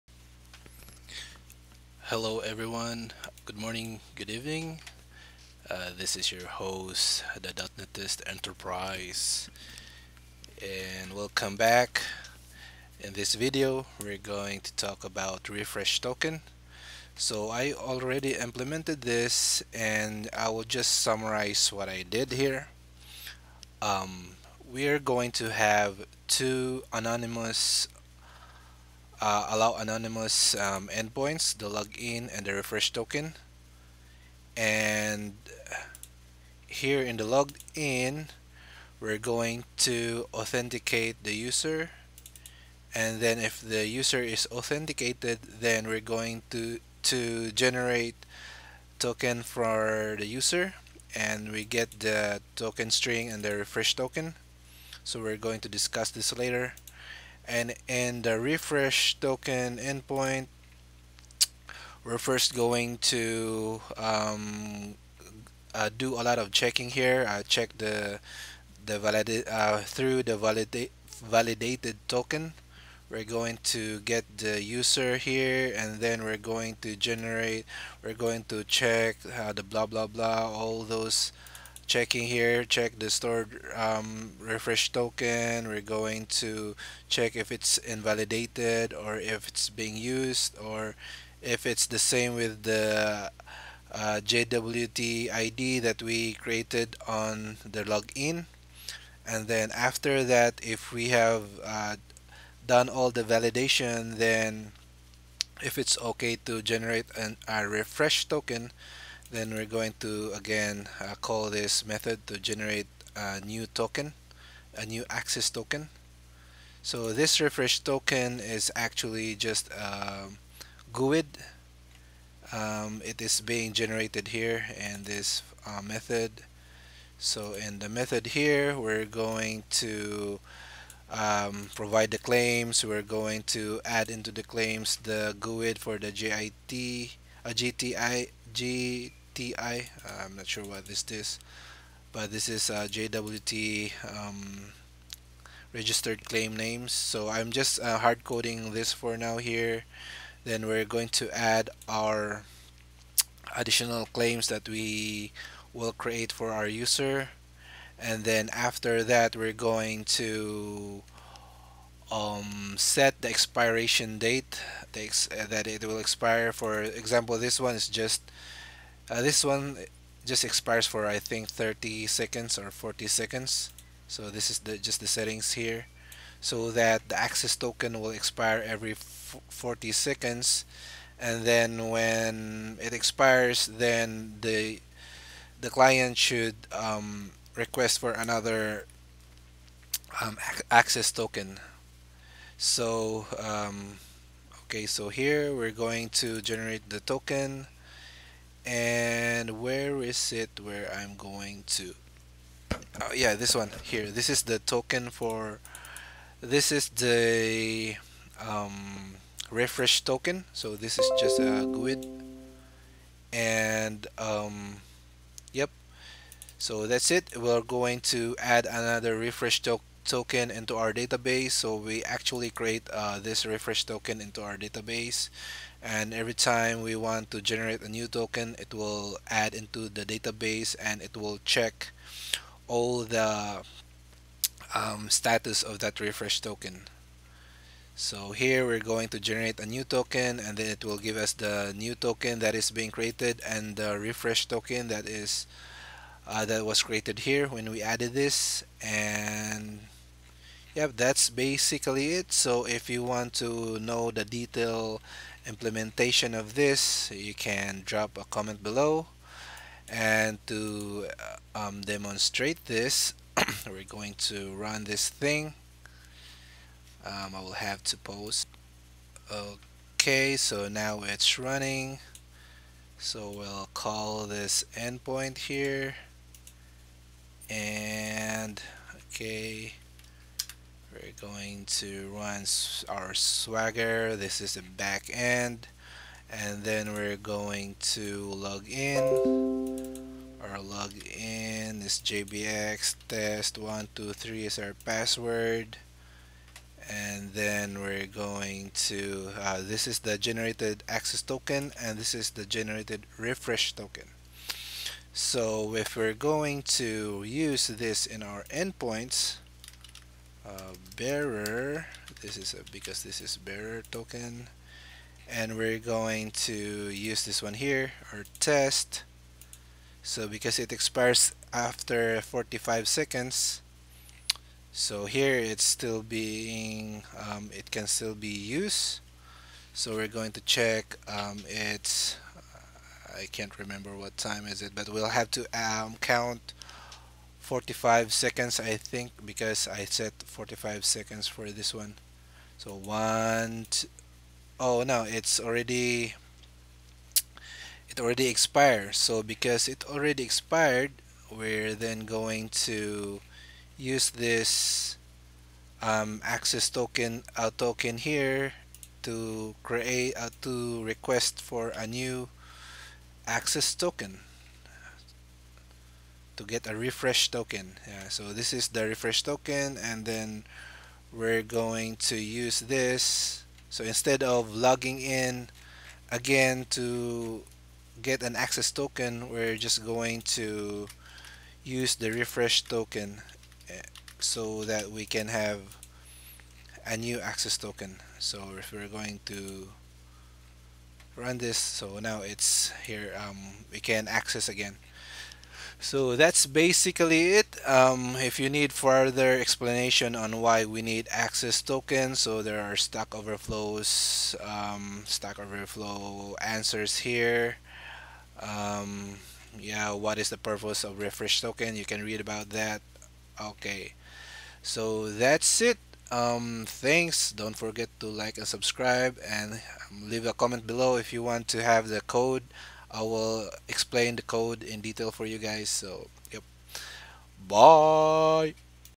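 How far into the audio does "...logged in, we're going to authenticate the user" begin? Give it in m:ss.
0:37.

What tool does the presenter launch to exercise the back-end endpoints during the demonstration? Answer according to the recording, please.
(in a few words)
Swagger.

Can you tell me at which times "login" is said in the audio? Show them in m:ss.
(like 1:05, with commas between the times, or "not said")
0:31, 1:37.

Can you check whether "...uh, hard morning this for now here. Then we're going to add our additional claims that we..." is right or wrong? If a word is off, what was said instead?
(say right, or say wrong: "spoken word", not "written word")
wrong: "coding", not "morning".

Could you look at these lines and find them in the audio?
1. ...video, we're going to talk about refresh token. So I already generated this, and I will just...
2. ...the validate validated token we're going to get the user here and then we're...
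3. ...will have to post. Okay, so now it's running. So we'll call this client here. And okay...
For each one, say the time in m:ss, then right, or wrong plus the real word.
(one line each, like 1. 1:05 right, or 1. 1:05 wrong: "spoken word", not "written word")
1. 0:13 wrong: "implemented", not "generated"
2. 1:10 right
3. 4:27 wrong: "endpoint", not "client".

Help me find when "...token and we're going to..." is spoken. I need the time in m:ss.
5:13.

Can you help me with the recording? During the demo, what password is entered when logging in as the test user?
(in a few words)
test 123.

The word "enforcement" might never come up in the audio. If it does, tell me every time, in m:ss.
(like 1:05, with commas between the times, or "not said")
not said.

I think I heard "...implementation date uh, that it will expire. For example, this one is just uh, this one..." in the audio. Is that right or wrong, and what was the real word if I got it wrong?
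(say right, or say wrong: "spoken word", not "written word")
wrong: "expiration", not "implementation".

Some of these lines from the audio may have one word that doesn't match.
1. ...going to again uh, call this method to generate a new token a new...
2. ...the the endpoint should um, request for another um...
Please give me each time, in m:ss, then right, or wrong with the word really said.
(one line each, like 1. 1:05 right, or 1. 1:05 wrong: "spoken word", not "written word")
1. 1:49 right
2. 3:04 wrong: "client", not "endpoint".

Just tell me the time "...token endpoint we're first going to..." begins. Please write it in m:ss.
0:59.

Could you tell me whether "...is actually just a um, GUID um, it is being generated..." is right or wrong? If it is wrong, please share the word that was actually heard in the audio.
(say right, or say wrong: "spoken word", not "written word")
right.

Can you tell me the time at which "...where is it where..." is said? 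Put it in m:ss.
3:19.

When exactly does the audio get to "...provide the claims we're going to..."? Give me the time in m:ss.
2:11.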